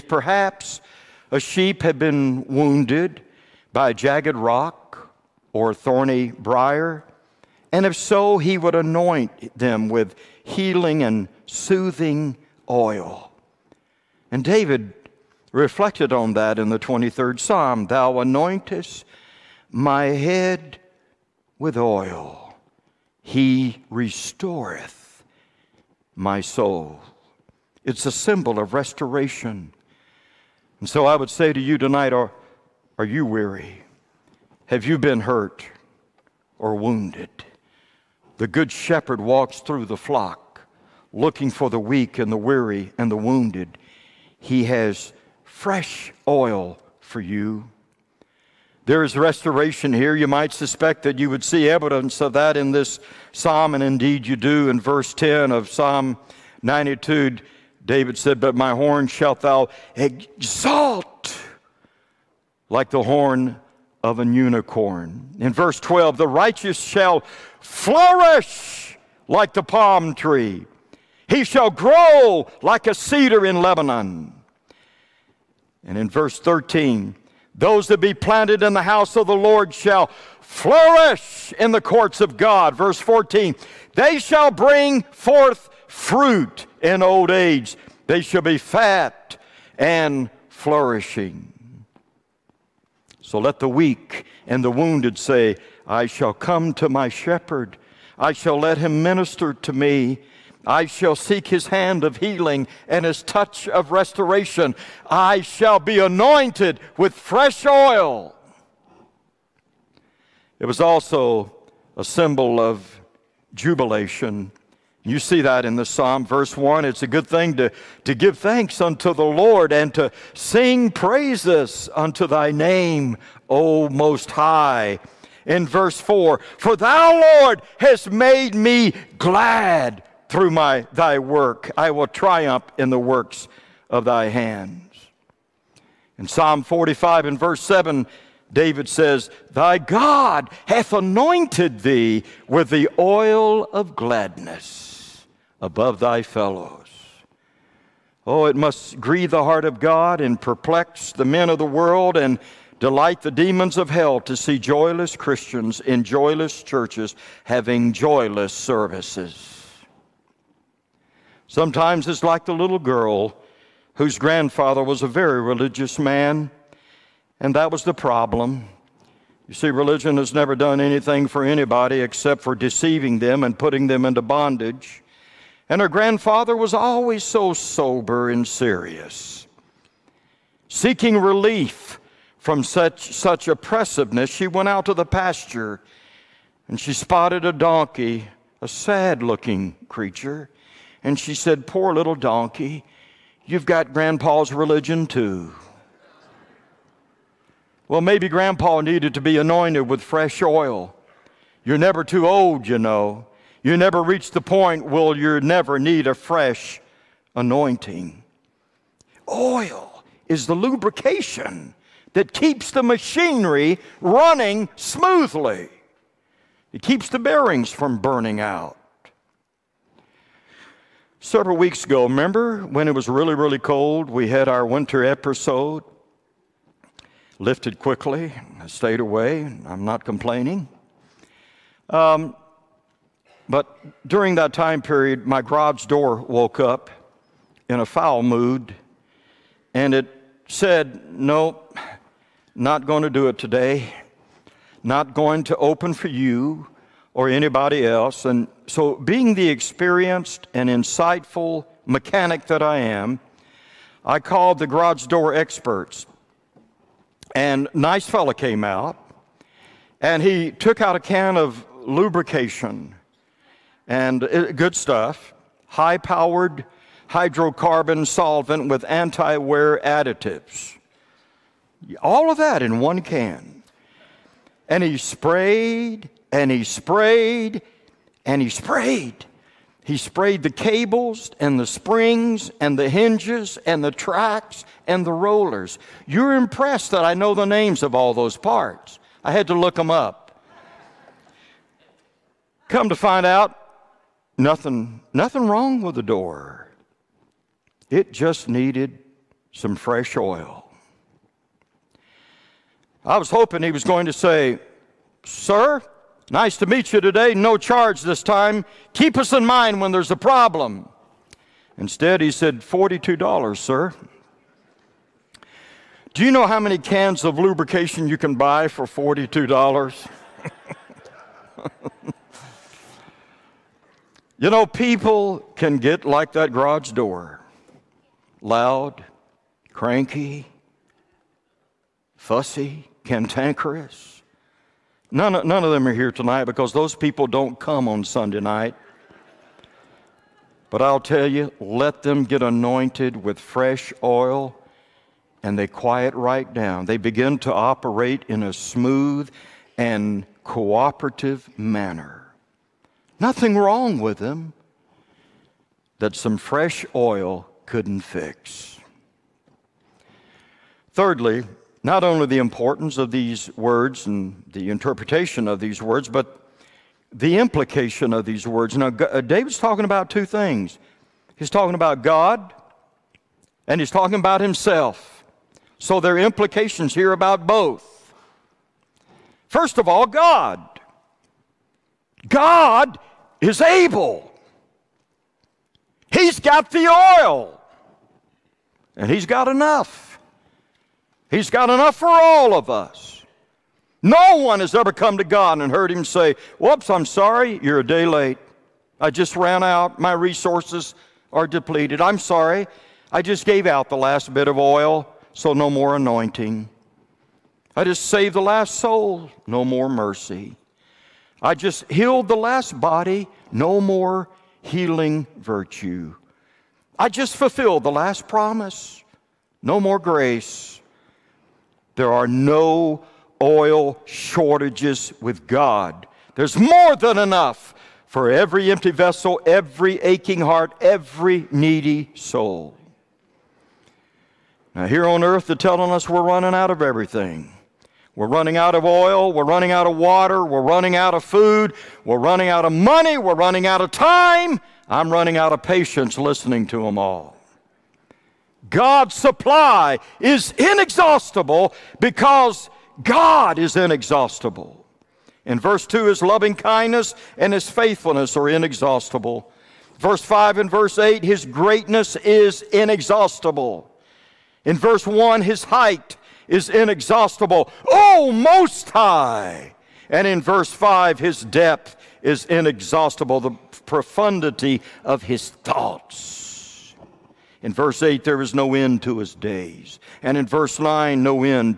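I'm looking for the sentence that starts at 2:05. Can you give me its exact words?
In verse 4, for thou, Lord, hast made me glad through my thy work.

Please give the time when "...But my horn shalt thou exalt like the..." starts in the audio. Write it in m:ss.
0:58.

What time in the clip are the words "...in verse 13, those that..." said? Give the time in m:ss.
1:15.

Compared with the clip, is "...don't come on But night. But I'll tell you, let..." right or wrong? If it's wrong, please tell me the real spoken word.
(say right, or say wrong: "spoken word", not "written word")
wrong: "Sunday", not "But".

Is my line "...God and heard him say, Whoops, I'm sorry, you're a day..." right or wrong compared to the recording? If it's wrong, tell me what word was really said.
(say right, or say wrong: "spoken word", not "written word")
right.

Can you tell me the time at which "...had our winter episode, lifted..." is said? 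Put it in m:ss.
3:44.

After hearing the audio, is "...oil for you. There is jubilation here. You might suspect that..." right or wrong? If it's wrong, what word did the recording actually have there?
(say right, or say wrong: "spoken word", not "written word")
wrong: "restoration", not "jubilation".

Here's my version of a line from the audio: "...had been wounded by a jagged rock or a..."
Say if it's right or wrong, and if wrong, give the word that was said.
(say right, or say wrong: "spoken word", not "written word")
right.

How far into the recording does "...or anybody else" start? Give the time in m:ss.
4:07.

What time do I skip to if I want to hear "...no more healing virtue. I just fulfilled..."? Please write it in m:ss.
6:53.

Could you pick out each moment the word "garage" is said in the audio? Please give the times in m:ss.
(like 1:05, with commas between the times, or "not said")
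3:55, 4:14, 5:26.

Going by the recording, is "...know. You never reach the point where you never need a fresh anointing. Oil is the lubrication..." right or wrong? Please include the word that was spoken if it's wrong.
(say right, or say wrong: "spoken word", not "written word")
right.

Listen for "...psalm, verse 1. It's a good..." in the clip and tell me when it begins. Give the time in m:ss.
1:55.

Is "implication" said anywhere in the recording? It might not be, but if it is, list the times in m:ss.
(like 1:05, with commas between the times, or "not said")
6:07, 6:16.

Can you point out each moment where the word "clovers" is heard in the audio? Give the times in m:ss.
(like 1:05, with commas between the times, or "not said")
not said.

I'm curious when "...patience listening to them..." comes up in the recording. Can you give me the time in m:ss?
7:25.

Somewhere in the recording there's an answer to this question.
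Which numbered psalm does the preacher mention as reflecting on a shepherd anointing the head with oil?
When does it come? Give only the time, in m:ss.
0:16.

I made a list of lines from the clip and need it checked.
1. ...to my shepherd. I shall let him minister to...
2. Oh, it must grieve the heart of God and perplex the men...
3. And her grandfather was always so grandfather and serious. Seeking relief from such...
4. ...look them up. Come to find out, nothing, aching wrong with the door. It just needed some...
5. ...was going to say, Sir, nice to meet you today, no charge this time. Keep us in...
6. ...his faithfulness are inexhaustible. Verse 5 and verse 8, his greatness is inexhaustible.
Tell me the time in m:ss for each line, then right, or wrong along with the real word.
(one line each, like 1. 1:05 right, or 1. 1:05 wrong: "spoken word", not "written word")
1. 1:36 right
2. 2:28 right
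3. 2:55 wrong: "sober", not "grandfather"
4. 4:49 wrong: "nothing", not "aching"
5. 5:03 right
6. 7:37 right.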